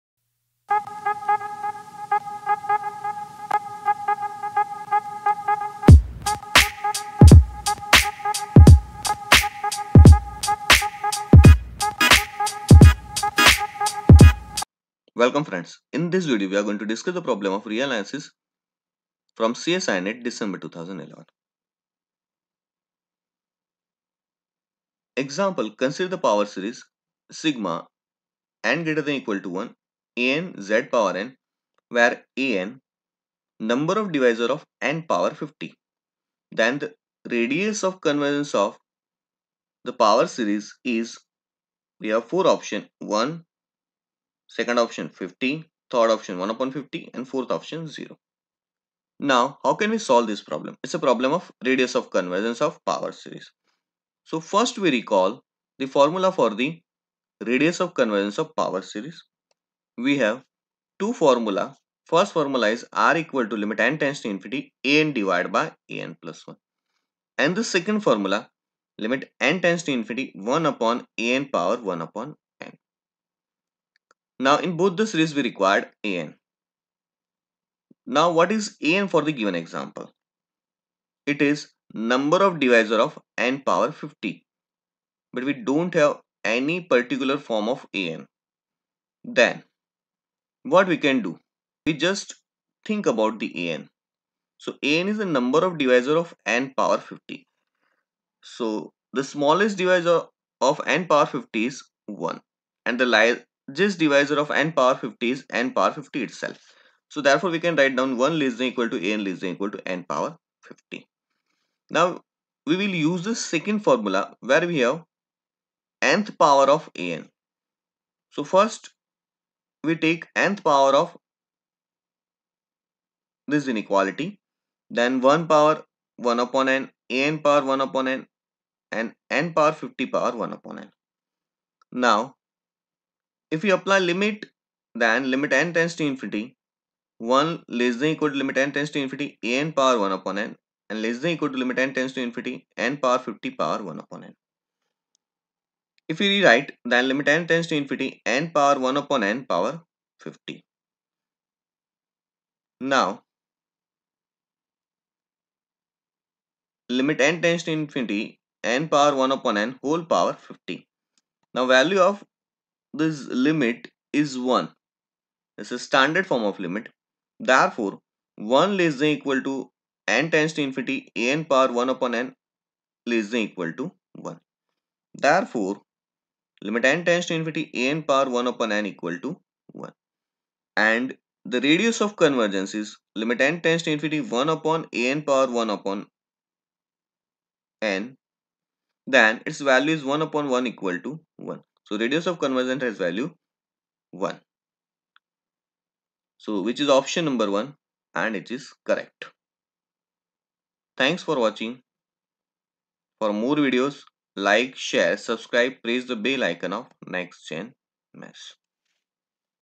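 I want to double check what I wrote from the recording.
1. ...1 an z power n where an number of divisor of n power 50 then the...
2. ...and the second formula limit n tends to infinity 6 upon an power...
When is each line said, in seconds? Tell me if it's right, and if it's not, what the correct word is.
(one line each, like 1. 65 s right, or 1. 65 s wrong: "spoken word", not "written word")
1. 29 s right
2. 67 s wrong: "1", not "6".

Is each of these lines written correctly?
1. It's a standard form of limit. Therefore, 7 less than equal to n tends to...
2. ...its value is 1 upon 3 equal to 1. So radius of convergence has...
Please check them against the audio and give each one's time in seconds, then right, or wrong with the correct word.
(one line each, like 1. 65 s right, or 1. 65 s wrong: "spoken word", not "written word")
1. 165 s wrong: "1", not "7"
2. 189 s wrong: "1", not "3".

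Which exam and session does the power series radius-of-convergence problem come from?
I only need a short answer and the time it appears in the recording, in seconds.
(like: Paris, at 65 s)
CSIR NET December 2011, at 19 s.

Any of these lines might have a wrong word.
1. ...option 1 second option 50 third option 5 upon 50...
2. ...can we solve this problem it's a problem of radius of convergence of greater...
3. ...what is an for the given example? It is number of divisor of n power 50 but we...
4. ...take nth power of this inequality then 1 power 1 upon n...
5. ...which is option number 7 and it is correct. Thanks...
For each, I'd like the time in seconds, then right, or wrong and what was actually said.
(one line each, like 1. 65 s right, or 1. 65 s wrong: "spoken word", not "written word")
1. 42 s wrong: "1", not "5"
2. 49 s wrong: "power", not "greater"
3. 78 s right
4. 120 s right
5. 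196 s wrong: "1", not "7".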